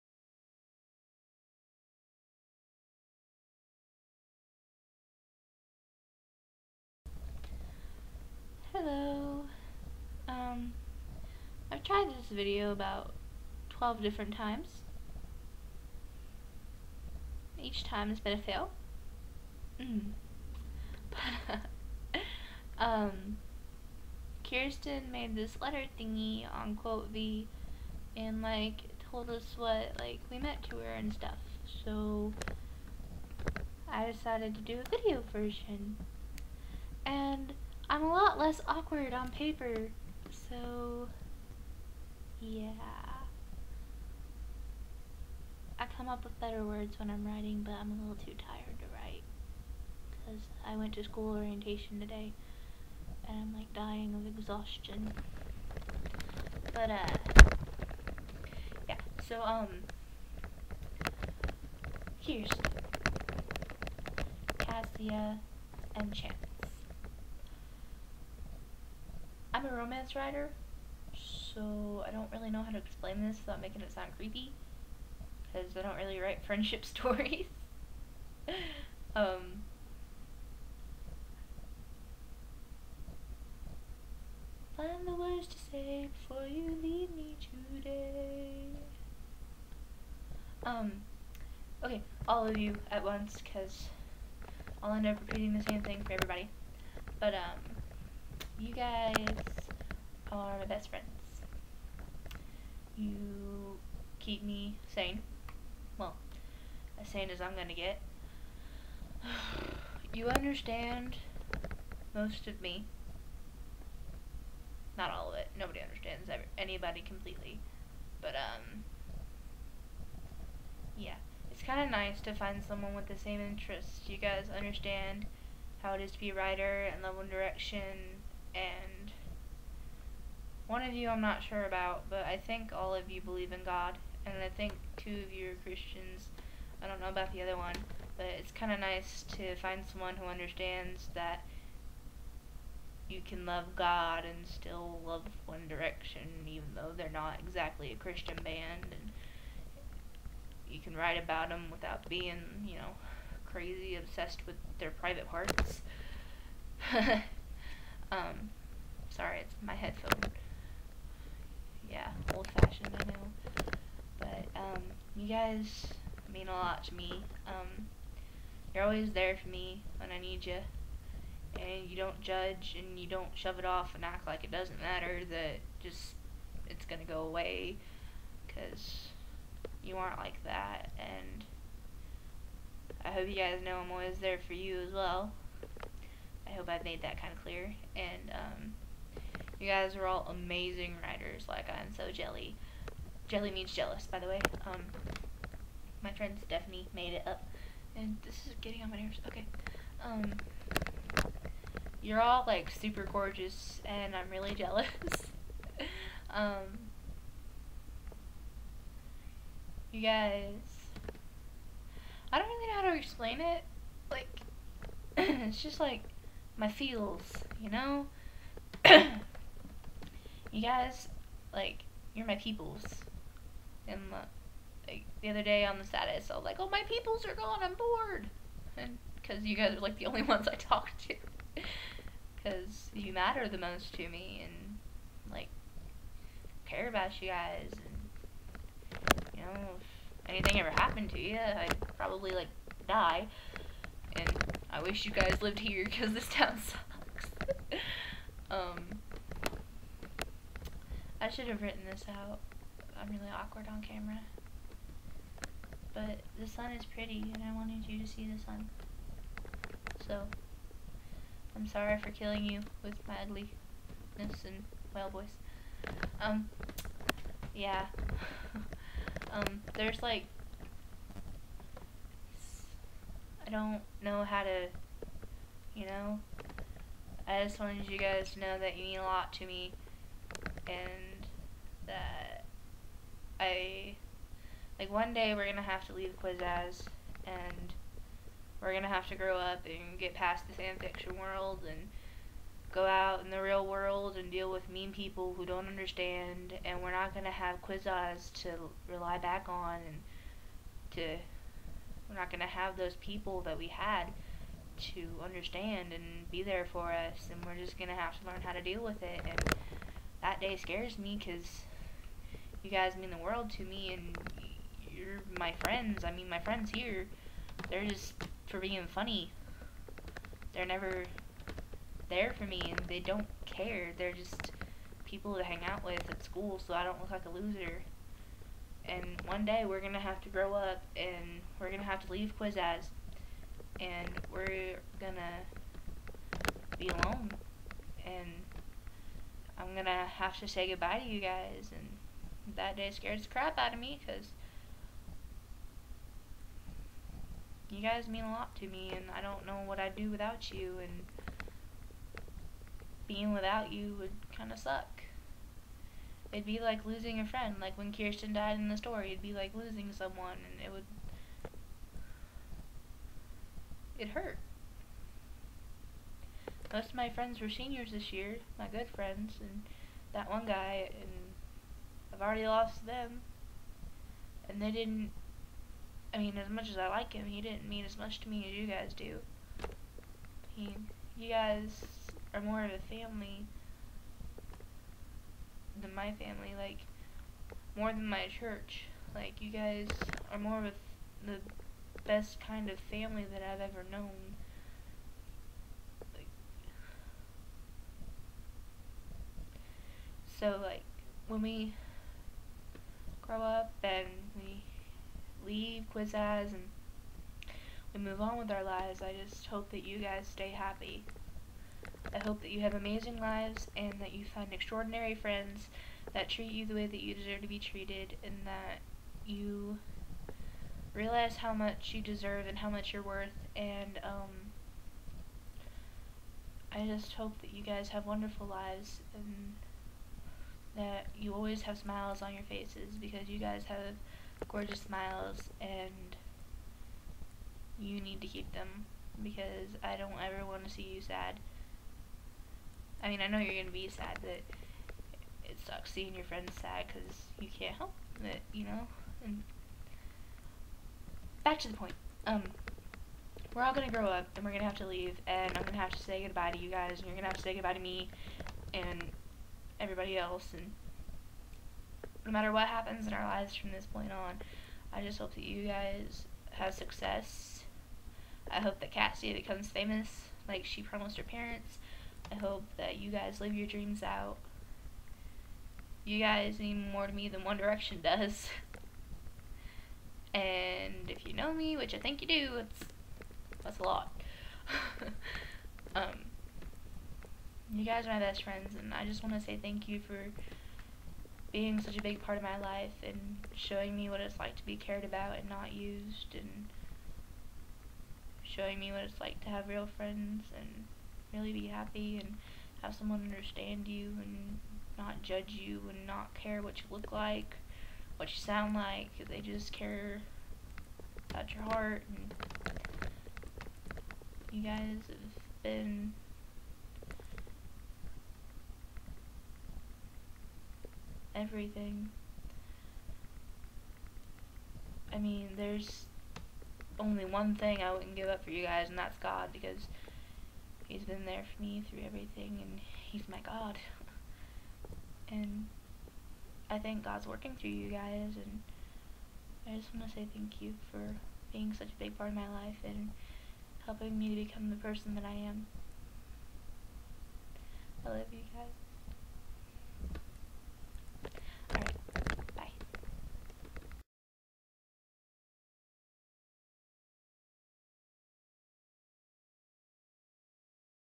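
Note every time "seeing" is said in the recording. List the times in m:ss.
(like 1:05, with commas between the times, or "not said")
7:25.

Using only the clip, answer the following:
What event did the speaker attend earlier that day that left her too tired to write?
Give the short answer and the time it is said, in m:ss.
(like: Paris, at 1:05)
school orientation, at 0:51.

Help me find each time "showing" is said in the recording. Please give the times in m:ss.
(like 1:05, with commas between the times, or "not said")
8:13, 8:18.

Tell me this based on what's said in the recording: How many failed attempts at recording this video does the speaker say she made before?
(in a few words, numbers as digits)
12.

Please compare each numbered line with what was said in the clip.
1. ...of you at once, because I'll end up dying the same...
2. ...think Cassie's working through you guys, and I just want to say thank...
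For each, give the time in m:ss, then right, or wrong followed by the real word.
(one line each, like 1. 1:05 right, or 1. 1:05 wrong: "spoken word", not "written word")
1. 1:32 wrong: "repeating", not "dying"
2. 8:56 wrong: "God", not "Cassie".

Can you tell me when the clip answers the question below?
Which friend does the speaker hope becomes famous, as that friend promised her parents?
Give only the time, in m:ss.
7:48.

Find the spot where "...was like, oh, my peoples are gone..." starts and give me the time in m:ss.
3:46.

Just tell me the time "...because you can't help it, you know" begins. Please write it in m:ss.
7:26.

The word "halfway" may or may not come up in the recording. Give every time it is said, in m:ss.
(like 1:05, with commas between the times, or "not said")
not said.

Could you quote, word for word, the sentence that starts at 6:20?
He, you guys are more of a family than my family, like, more than my church.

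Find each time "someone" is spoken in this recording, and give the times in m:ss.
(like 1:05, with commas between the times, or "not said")
2:02, 2:19, 5:59, 8:22.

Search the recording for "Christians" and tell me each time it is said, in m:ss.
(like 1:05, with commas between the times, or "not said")
2:15, 2:28.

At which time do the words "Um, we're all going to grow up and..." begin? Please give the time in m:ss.
7:32.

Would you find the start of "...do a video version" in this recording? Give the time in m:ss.
0:34.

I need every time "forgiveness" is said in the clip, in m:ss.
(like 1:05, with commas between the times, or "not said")
not said.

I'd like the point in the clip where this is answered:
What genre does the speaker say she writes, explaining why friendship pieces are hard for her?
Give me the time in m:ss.
1:09.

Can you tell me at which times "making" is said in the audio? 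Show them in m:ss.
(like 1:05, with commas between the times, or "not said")
1:13.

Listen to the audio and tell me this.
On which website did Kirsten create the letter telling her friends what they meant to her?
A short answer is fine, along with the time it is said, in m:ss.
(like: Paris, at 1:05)
Quotev, at 0:26.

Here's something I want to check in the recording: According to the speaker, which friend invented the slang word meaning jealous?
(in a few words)
Stephanie.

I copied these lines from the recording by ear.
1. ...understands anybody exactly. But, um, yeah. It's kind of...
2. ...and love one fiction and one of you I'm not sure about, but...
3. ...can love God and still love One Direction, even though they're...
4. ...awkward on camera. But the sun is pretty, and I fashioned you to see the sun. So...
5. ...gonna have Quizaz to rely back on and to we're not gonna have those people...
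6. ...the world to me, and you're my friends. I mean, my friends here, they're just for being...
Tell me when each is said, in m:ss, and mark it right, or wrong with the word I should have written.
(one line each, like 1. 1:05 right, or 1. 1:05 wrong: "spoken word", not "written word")
1. 1:55 wrong: "completely", not "exactly"
2. 2:06 wrong: "direction", not "fiction"
3. 2:23 right
4. 4:13 wrong: "wanted", not "fashioned"
5. 4:57 right
6. 5:13 right.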